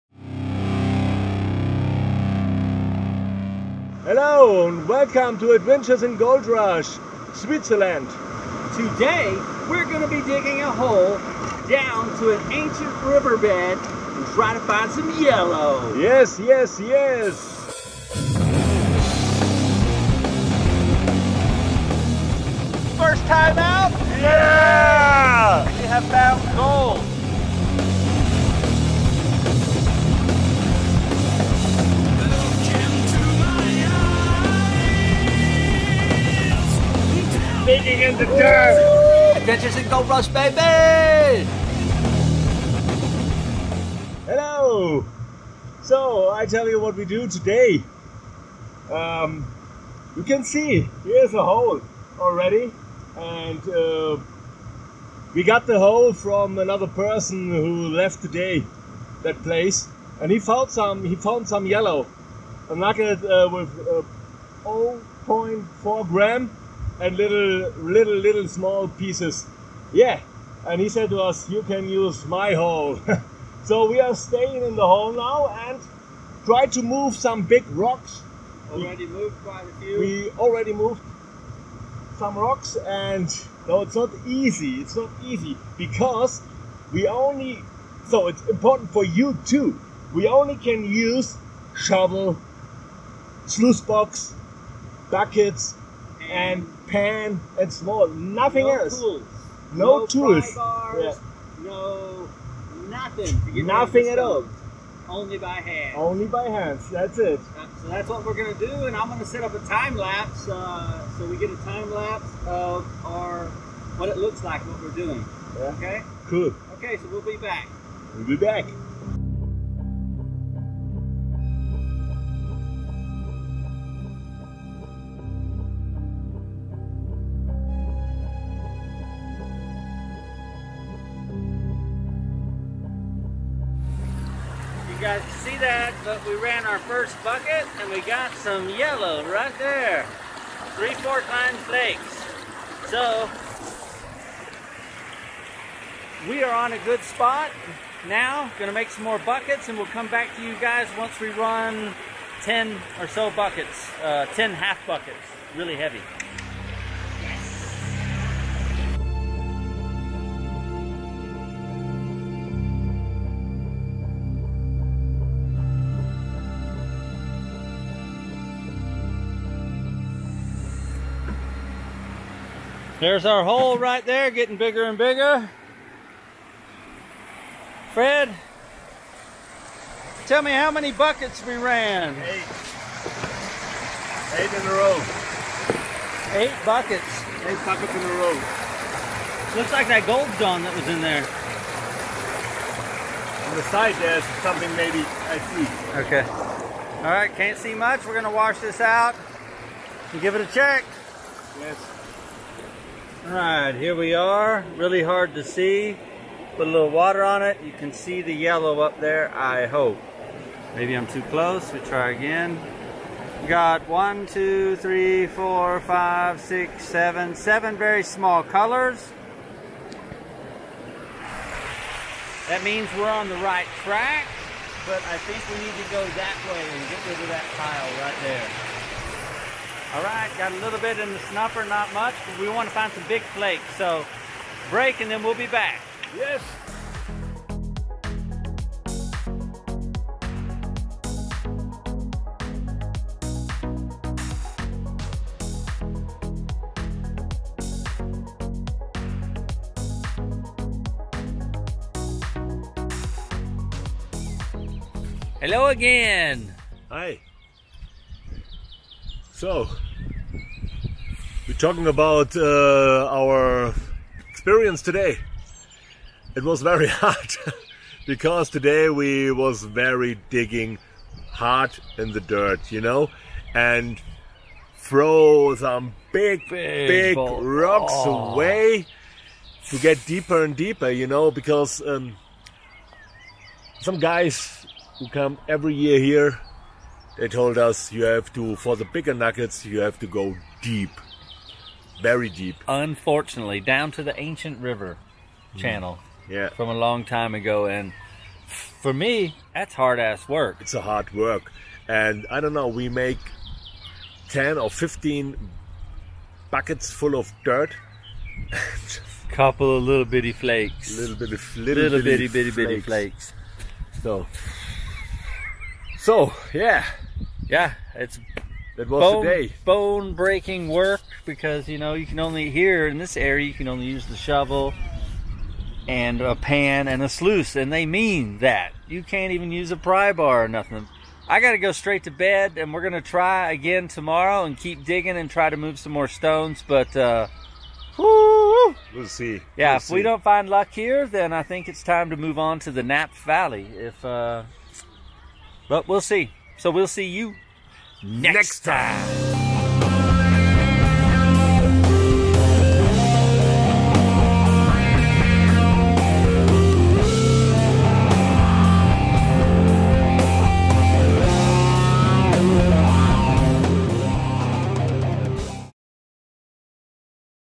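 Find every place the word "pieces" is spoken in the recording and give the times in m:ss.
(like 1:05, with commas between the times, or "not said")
1:08.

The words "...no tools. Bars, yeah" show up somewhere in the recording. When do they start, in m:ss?
1:39.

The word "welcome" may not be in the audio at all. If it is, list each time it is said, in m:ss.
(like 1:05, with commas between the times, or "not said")
0:04.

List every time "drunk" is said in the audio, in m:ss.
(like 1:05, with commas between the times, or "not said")
not said.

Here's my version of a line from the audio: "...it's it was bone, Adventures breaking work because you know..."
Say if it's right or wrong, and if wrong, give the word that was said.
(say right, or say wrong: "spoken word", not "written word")
wrong: "Bone", not "Adventures".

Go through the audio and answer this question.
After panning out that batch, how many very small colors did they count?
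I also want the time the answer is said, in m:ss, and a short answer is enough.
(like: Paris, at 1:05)
7, at 3:37.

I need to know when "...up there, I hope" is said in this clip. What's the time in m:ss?
3:28.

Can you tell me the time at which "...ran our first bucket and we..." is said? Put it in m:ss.
2:16.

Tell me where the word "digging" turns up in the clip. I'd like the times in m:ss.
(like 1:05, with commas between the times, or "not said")
0:10, 4:30, 5:34.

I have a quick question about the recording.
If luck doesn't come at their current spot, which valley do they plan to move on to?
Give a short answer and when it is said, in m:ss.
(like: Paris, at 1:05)
Nap Valley, at 5:42.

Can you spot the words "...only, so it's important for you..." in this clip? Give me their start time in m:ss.
1:27.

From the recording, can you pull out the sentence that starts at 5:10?
Little bitty, little, little bitty, bitty, bitty, bitty flakes.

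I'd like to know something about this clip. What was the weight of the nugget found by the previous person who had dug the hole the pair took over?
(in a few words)
0.4 gram.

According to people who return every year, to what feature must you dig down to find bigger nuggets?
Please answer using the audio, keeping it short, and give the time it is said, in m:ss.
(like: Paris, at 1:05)
ancient river channel, at 4:54.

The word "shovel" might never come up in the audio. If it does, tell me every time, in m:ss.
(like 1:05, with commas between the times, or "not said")
1:31, 5:24.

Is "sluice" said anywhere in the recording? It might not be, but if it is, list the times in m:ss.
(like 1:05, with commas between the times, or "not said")
1:33, 5:27.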